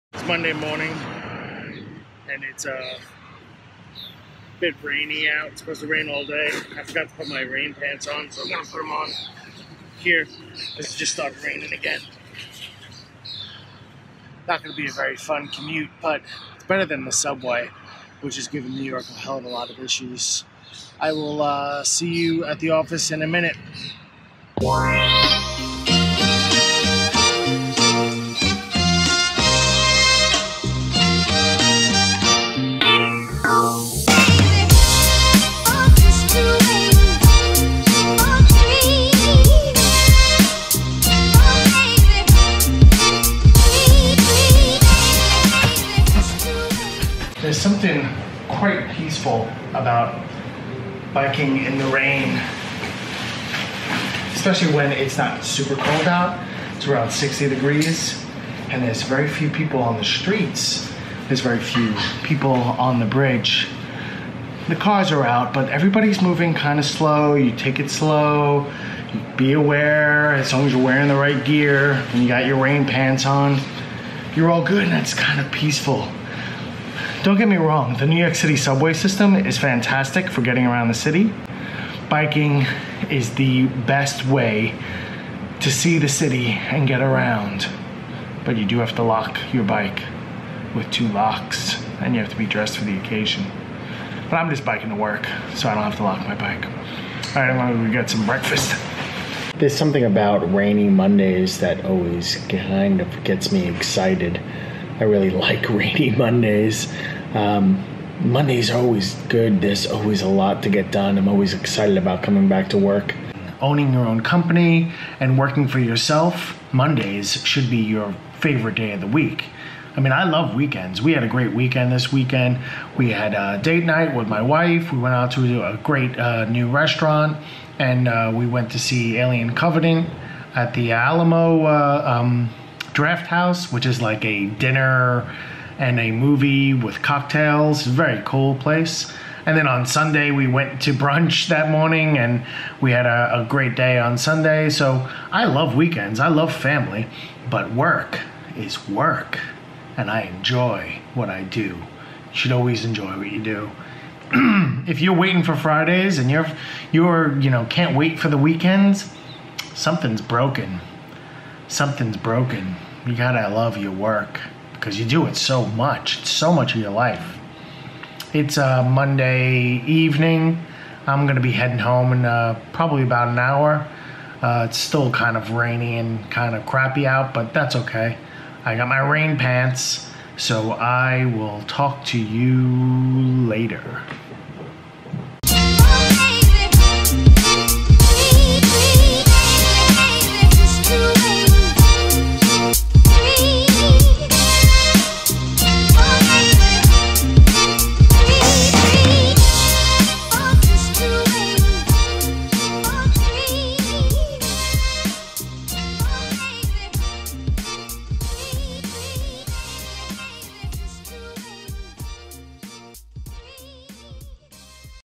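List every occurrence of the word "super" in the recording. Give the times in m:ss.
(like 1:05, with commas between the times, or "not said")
0:55.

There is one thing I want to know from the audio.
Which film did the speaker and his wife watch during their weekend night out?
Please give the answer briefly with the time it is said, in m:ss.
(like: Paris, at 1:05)
Alien Covenant, at 2:09.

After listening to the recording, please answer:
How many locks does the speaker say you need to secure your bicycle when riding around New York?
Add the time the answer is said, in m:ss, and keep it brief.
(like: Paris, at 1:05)
2, at 1:30.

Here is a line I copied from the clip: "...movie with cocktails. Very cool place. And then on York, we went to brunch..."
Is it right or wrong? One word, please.
wrong.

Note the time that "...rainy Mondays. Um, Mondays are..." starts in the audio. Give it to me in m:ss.
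1:45.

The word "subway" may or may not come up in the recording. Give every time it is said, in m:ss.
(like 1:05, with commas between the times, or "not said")
0:17, 1:18.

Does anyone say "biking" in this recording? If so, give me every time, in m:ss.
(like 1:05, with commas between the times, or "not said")
0:51, 1:22, 1:34.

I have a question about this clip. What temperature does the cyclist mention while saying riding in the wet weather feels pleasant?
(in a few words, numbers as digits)
60 degrees.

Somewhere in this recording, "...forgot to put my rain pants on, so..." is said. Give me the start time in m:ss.
0:06.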